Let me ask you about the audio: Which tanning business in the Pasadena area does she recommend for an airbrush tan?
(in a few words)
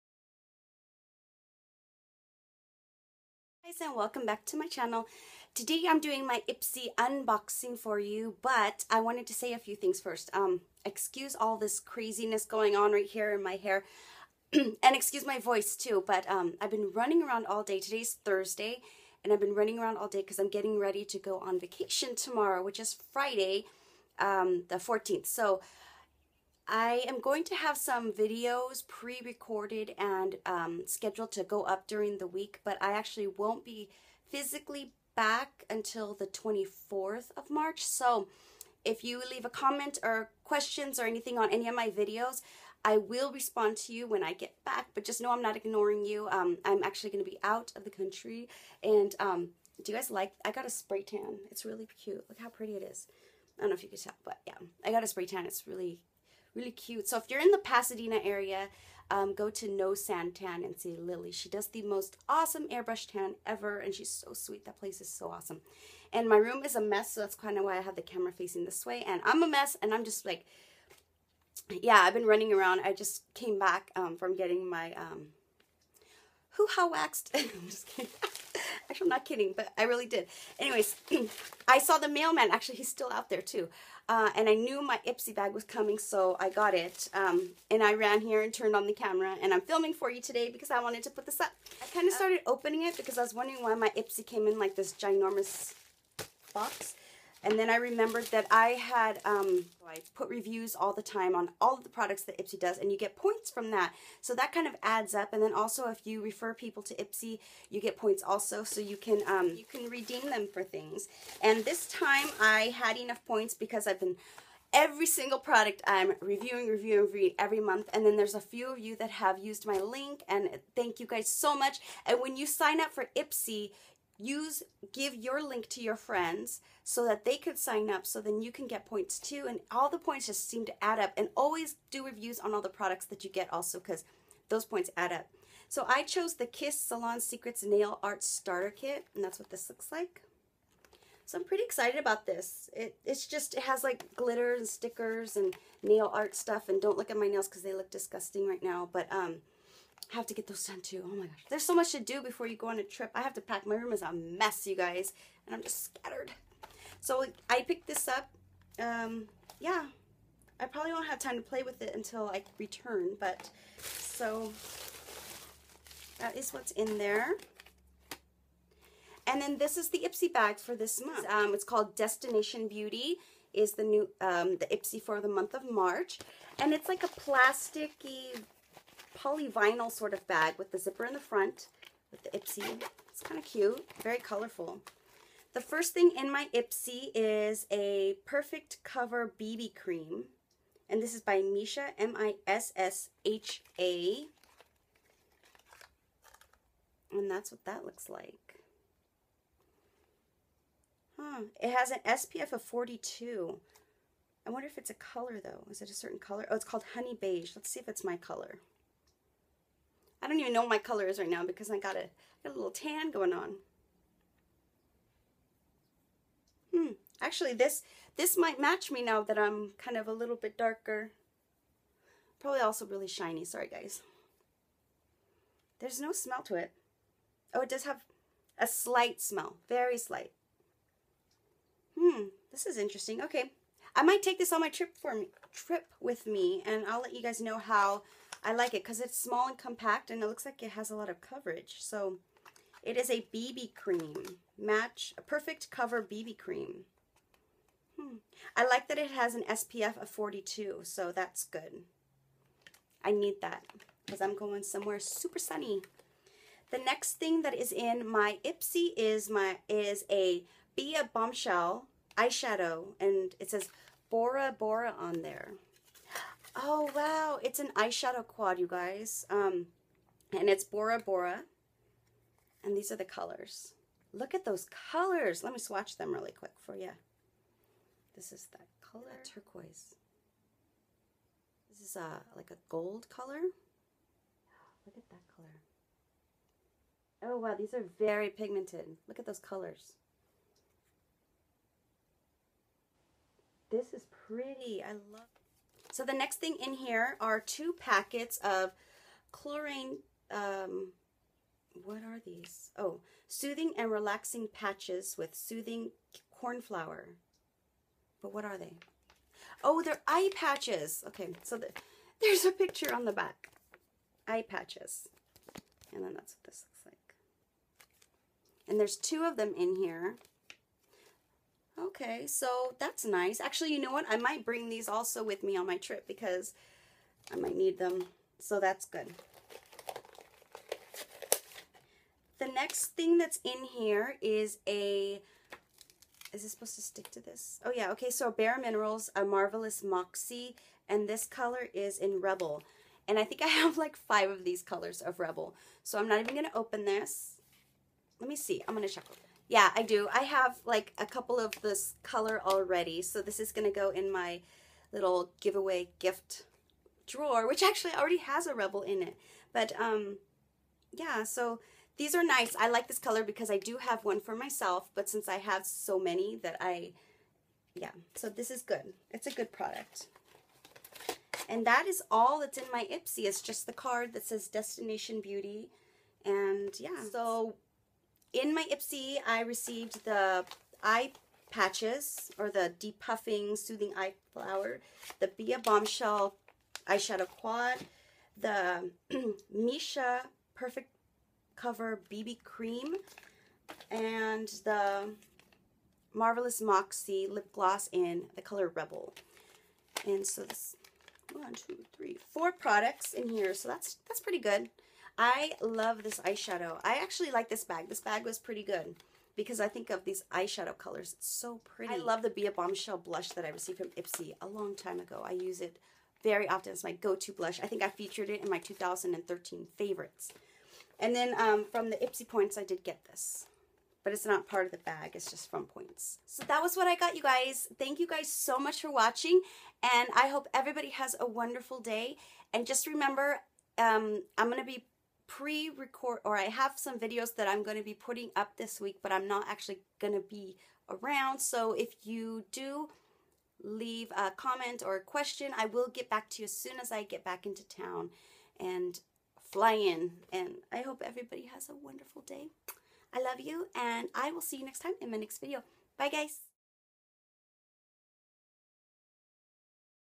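No Sand Tan.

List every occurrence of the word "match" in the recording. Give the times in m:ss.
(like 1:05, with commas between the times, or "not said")
3:38, 4:04.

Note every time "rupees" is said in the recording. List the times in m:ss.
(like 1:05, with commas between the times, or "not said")
not said.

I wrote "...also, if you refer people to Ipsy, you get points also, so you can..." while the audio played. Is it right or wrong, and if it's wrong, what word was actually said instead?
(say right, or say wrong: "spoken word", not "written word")
right.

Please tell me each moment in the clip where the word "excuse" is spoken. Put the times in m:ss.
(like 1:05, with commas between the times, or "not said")
0:10, 0:14.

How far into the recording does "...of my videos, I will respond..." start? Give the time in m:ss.
0:41.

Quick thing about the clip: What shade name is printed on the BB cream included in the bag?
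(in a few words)
Honey Beige.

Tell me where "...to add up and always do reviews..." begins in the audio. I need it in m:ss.
2:10.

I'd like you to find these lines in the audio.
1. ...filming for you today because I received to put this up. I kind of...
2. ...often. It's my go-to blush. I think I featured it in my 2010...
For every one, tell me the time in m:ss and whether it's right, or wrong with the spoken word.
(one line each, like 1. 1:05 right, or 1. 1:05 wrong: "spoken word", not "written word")
1. 1:29 wrong: "wanted", not "received"
2. 6:56 wrong: "2013", not "2010".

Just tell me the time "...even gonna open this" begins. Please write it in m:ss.
5:46.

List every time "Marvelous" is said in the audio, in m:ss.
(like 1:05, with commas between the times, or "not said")
5:39, 6:36.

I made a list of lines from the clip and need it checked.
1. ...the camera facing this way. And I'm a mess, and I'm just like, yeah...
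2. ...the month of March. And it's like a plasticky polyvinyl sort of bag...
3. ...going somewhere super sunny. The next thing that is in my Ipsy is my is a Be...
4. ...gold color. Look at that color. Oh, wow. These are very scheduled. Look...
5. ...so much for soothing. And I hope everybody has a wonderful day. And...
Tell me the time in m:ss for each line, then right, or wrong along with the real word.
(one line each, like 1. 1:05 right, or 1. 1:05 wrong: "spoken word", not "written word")
1. 1:07 right
2. 2:55 right
3. 4:14 right
4. 4:42 wrong: "pigmented", not "scheduled"
5. 7:08 wrong: "watching", not "soothing".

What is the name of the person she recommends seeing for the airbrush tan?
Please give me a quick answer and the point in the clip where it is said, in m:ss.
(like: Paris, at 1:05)
Lily, at 1:00.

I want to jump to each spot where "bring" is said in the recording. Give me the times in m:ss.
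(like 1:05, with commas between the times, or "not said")
5:24.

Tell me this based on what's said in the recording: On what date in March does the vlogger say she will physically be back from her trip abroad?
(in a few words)
24th of March.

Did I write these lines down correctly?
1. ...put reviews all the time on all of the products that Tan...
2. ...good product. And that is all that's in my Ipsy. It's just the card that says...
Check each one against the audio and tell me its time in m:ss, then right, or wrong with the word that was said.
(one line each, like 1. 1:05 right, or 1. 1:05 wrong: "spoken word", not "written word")
1. 1:40 wrong: "Ipsy", not "Tan"
2. 6:09 right.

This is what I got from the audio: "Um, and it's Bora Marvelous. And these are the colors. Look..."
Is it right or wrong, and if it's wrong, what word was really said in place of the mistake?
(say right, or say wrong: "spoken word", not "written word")
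wrong: "Bora", not "Marvelous".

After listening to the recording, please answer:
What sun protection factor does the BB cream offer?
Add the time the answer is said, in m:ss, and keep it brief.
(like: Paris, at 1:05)
42, at 3:22.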